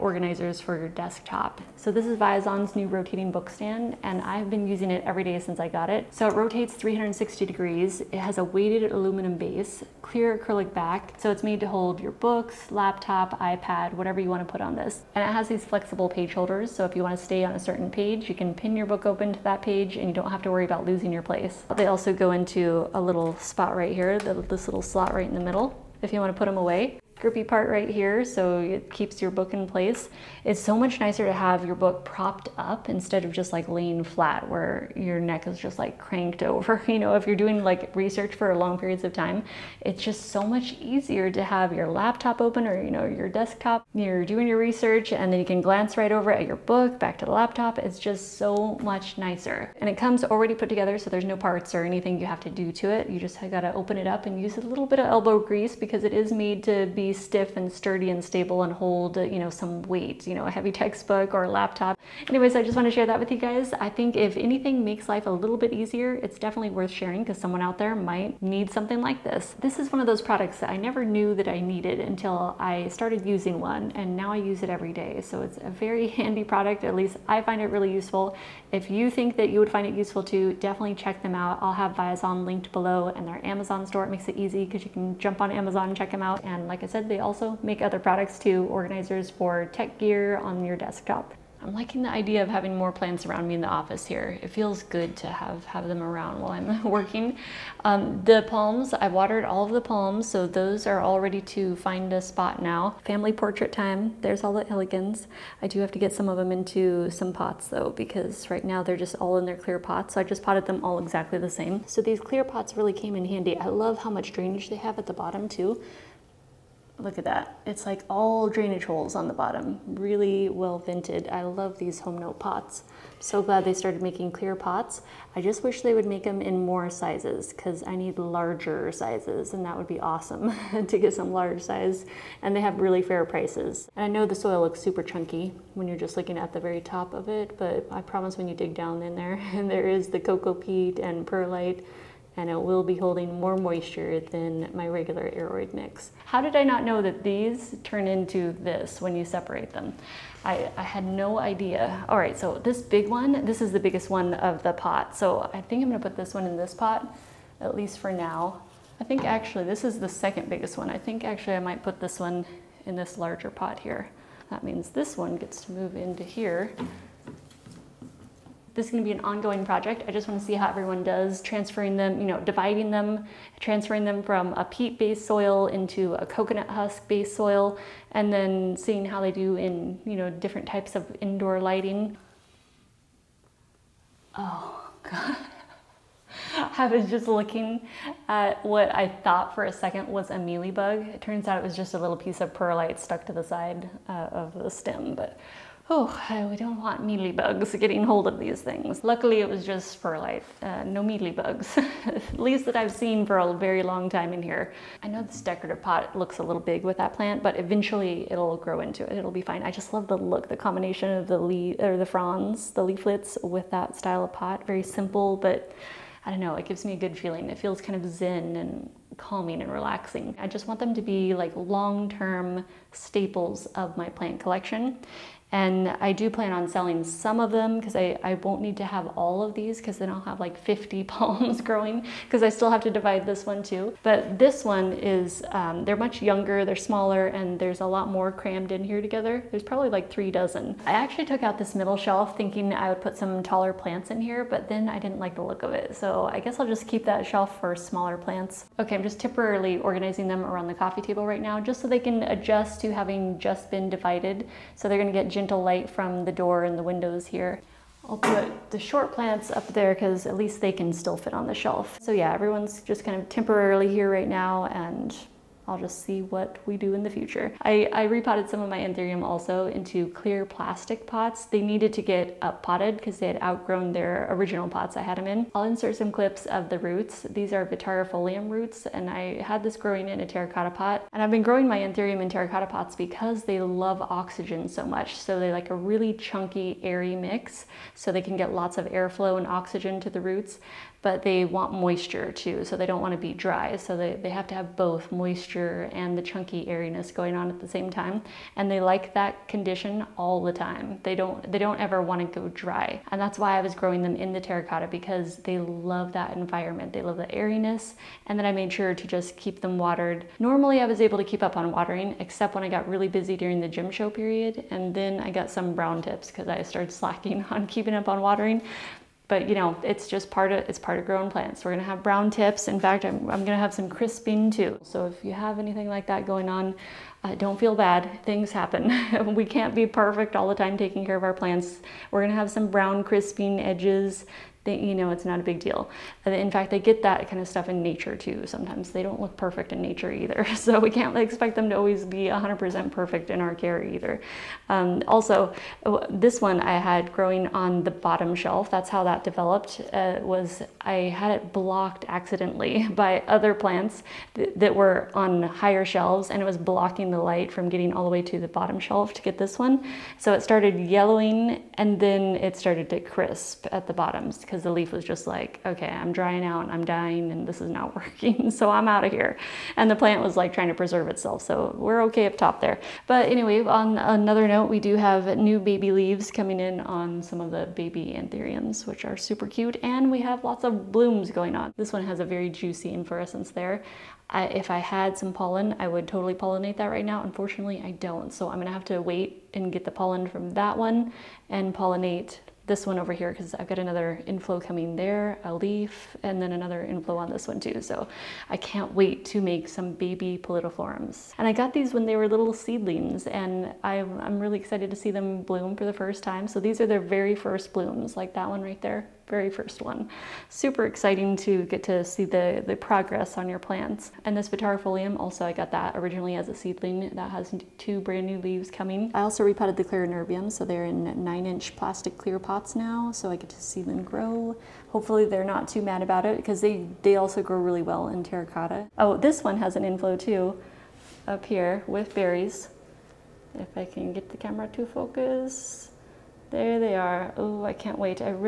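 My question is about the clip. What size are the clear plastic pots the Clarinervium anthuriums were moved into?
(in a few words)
9 inch.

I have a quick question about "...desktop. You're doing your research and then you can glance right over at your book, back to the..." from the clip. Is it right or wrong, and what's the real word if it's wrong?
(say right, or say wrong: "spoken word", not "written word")
right.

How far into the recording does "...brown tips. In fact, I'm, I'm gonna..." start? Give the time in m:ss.
5:22.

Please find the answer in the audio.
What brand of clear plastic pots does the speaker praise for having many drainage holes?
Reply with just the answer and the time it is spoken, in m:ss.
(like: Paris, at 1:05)
HomeNote, at 2:02.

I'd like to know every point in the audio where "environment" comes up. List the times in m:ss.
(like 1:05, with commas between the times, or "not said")
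5:06.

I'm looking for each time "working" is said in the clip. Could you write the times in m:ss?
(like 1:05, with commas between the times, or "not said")
1:36, 6:07.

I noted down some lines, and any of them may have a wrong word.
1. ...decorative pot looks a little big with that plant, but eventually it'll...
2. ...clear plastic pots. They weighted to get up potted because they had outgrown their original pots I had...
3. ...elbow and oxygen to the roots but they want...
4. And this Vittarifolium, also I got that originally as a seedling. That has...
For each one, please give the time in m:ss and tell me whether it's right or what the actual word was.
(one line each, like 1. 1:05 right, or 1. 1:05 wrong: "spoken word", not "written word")
1. 3:25 right
2. 4:30 wrong: "needed", not "weighted"
3. 4:48 wrong: "airflow", not "elbow"
4. 6:54 right.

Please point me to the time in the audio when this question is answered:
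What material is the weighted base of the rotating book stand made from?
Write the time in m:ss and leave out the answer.
0:08.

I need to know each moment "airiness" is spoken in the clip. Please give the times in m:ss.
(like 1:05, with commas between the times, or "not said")
4:56, 5:07.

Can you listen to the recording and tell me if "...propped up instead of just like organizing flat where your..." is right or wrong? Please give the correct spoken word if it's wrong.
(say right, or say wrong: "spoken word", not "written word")
wrong: "laying", not "organizing".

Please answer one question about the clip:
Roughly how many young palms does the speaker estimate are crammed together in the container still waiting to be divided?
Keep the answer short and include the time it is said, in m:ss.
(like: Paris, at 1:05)
3 dozen, at 4:00.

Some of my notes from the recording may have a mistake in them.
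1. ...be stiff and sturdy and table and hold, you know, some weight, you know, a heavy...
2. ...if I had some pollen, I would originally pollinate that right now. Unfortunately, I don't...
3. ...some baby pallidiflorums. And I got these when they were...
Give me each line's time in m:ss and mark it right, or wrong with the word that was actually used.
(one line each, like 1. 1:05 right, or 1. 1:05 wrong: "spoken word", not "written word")
1. 0:56 wrong: "stable", not "table"
2. 6:24 wrong: "totally", not "originally"
3. 6:39 right.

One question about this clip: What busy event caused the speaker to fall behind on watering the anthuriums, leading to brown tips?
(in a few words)
The gem show.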